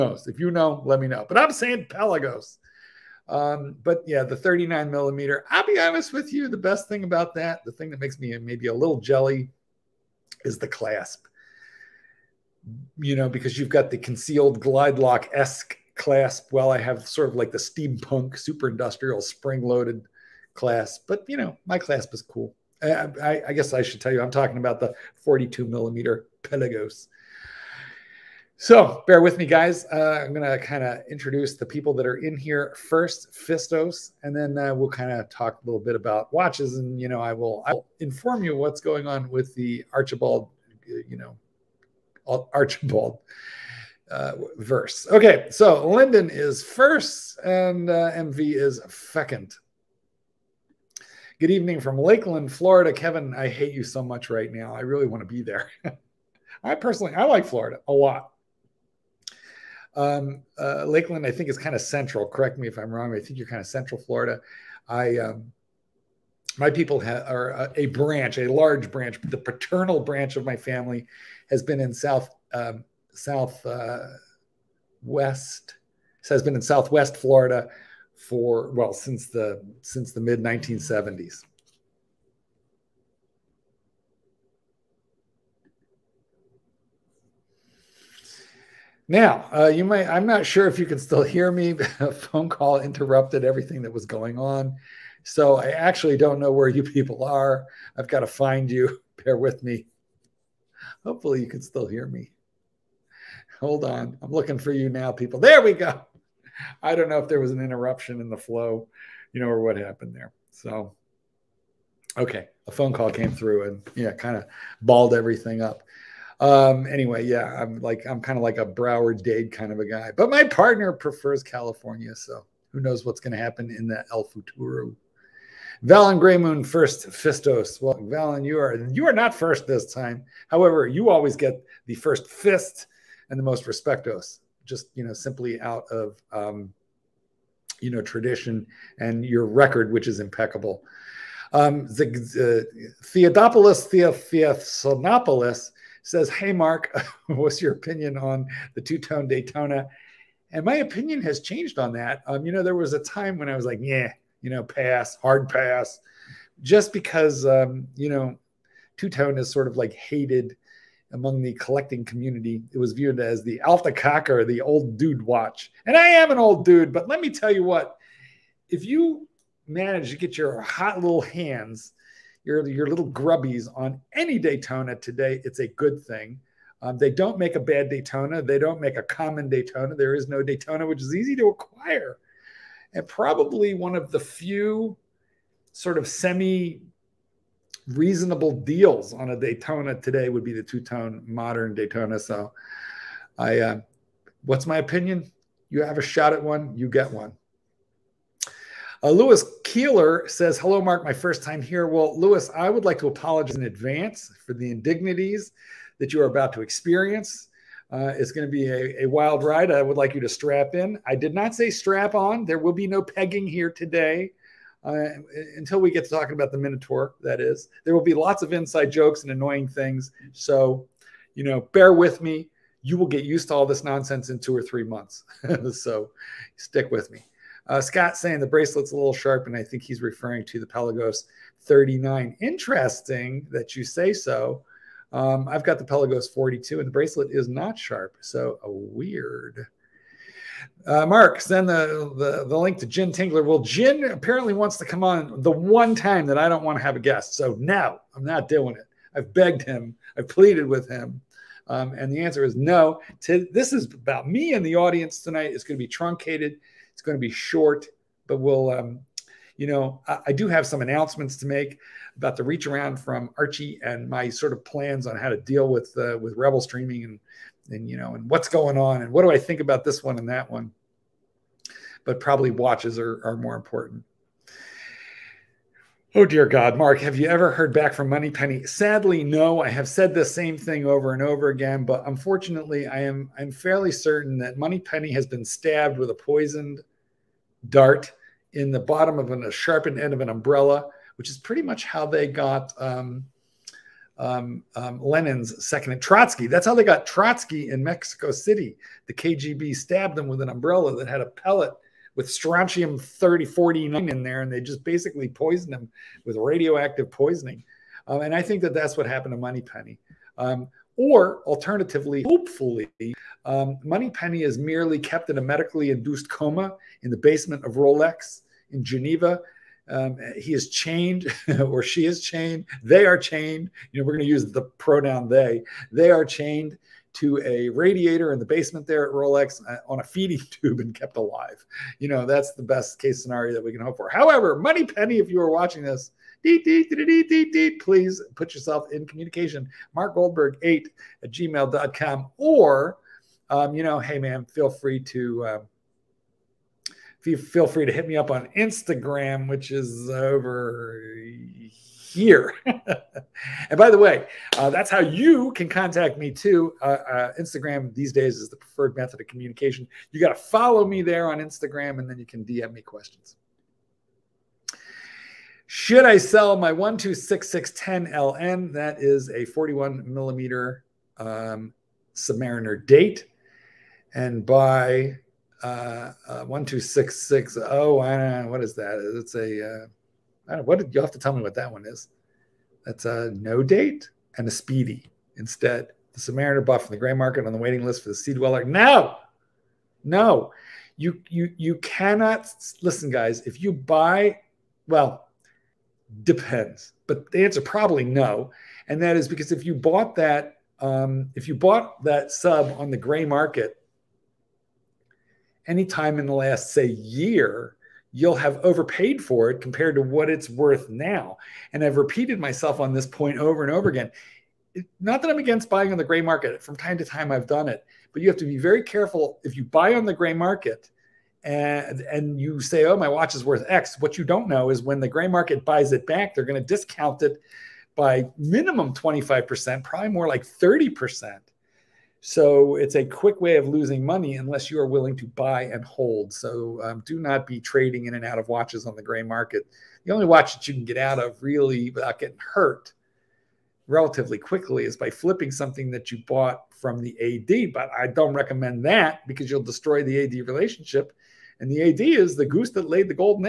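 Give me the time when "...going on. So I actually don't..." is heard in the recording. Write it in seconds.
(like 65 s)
94 s.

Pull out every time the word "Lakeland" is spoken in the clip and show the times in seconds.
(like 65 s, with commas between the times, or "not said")
51 s, 60 s.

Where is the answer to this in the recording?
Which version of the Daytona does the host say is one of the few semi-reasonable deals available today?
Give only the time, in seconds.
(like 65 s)
190 s.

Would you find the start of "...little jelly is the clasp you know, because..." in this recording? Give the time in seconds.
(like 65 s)
8 s.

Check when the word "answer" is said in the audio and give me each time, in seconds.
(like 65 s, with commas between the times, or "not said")
252 s, 397 s.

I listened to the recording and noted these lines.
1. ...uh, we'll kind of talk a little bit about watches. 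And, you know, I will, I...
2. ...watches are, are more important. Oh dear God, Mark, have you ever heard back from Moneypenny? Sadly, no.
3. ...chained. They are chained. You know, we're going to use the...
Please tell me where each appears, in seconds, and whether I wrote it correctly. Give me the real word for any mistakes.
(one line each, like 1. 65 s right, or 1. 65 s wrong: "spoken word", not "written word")
1. 34 s right
2. 272 s right
3. 322 s right.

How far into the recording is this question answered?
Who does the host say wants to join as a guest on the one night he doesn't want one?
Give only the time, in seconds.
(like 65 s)
242 s.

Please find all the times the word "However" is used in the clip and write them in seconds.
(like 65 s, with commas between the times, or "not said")
130 s, 334 s.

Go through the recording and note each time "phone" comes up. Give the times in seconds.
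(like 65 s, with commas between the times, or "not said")
92 s, 112 s.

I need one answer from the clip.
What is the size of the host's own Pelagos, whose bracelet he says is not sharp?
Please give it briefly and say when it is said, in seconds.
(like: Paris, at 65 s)
42 millimeter, at 235 s.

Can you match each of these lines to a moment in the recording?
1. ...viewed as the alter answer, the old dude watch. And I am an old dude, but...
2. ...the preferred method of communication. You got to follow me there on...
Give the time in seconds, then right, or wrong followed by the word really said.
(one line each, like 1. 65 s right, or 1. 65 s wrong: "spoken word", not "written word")
1. 162 s wrong: "kocker", not "answer"
2. 358 s right.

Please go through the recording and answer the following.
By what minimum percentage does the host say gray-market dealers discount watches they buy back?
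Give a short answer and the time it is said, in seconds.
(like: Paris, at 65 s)
25%, at 428 s.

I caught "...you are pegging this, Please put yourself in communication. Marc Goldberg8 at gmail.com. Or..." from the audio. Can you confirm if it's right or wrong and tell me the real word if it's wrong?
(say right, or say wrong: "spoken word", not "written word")
wrong: "watching", not "pegging".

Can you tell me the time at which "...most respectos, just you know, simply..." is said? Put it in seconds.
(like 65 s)
133 s.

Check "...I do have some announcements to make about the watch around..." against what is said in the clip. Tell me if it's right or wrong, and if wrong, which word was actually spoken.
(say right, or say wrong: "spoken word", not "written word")
wrong: "reach", not "watch".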